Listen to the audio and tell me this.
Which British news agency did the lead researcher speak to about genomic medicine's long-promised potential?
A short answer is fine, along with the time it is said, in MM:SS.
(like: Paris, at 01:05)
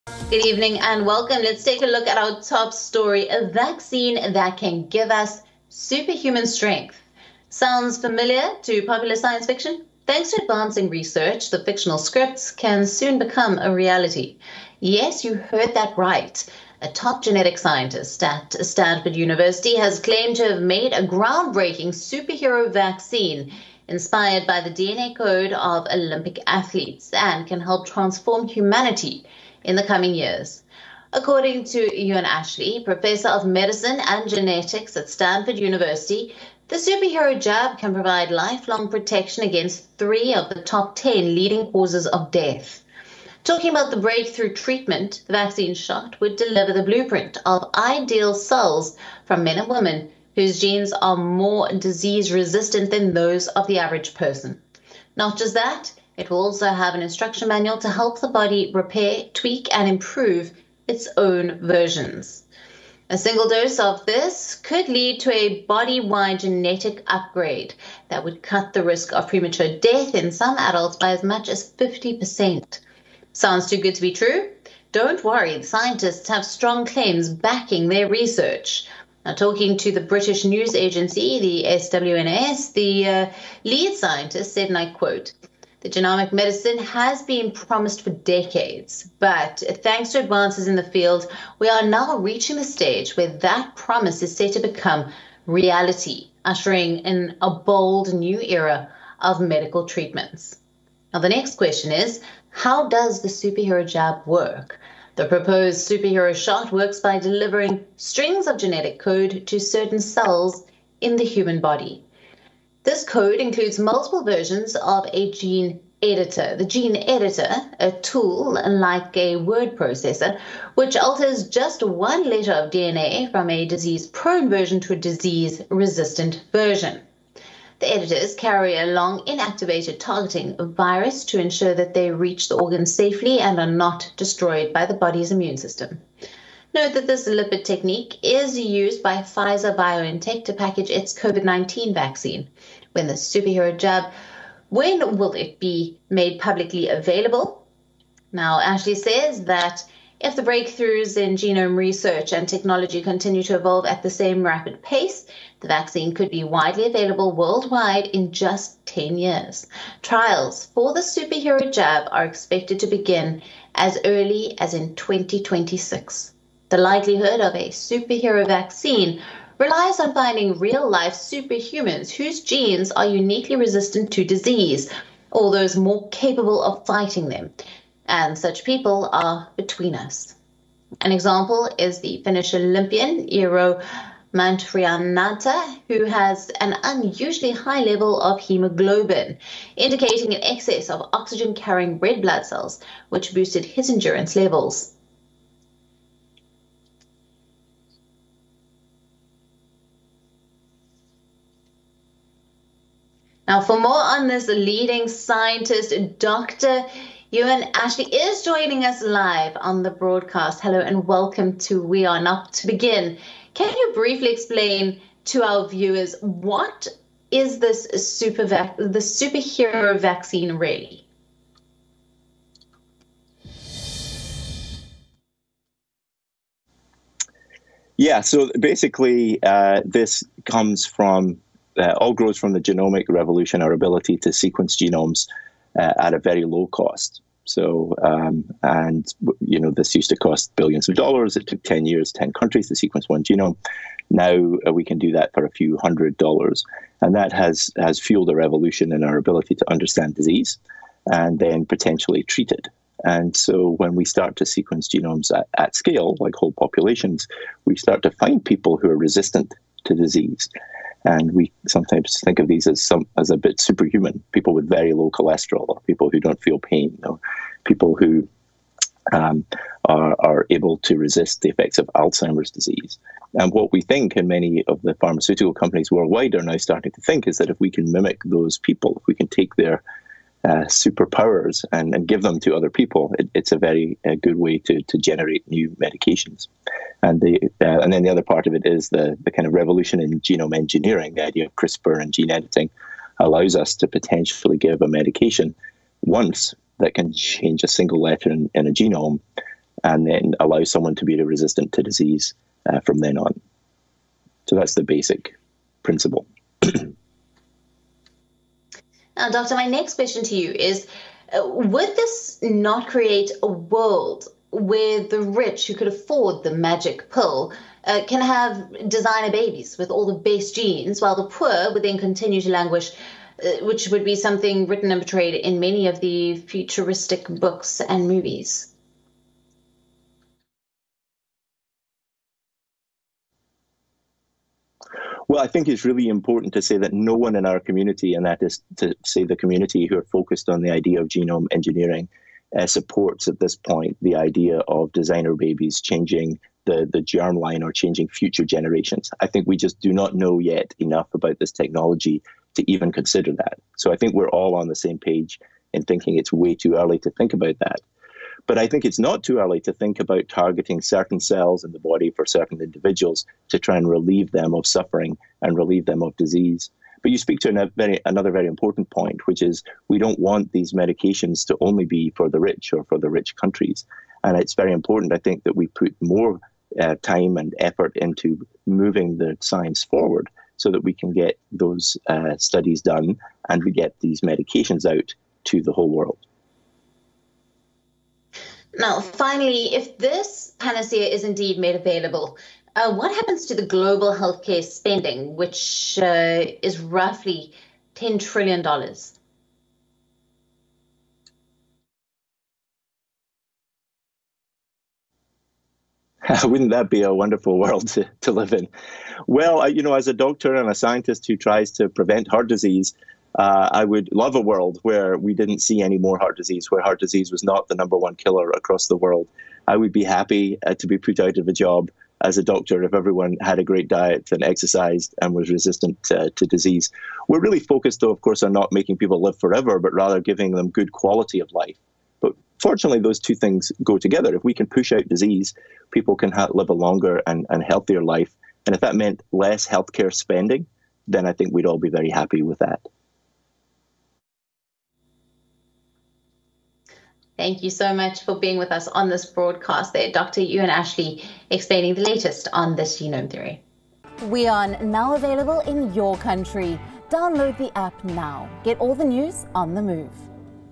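SWNS, at 01:21.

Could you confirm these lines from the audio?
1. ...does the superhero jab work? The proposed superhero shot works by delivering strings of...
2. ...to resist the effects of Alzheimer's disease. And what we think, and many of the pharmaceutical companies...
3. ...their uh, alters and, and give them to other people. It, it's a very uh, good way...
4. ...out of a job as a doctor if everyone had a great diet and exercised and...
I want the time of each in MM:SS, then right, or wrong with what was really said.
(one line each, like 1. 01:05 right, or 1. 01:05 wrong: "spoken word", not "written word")
1. 01:42 right
2. 04:30 right
3. 04:39 wrong: "superpowers", not "alters"
4. 07:01 right.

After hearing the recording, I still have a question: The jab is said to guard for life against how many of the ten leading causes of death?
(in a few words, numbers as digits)
3.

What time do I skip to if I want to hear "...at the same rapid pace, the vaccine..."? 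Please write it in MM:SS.
02:33.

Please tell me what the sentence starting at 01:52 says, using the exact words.
This code includes multiple versions of a gene editor.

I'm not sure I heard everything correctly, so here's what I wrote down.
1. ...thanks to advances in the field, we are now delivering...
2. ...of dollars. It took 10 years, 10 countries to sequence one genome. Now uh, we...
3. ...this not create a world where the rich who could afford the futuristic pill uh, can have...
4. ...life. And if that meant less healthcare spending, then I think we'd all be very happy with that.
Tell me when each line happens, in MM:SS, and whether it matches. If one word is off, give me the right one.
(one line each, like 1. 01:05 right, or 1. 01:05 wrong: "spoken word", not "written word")
1. 01:29 wrong: "reaching", not "delivering"
2. 04:00 right
3. 05:11 wrong: "magic", not "futuristic"
4. 07:18 right.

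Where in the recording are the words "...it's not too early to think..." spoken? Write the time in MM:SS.
05:58.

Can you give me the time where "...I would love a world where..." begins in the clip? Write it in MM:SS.
06:53.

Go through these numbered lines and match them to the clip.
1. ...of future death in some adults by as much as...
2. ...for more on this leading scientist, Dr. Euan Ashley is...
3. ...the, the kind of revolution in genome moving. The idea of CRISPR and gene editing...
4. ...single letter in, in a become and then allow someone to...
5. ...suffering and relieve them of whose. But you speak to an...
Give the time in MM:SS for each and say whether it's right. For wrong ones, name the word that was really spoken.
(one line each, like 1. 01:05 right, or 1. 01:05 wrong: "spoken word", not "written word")
1. 01:09 wrong: "premature", not "future"
2. 03:23 right
3. 04:48 wrong: "engineering", not "moving"
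4. 04:57 wrong: "genome", not "become"
5. 06:04 wrong: "disease", not "whose".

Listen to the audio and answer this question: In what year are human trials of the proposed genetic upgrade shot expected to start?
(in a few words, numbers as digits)
2026.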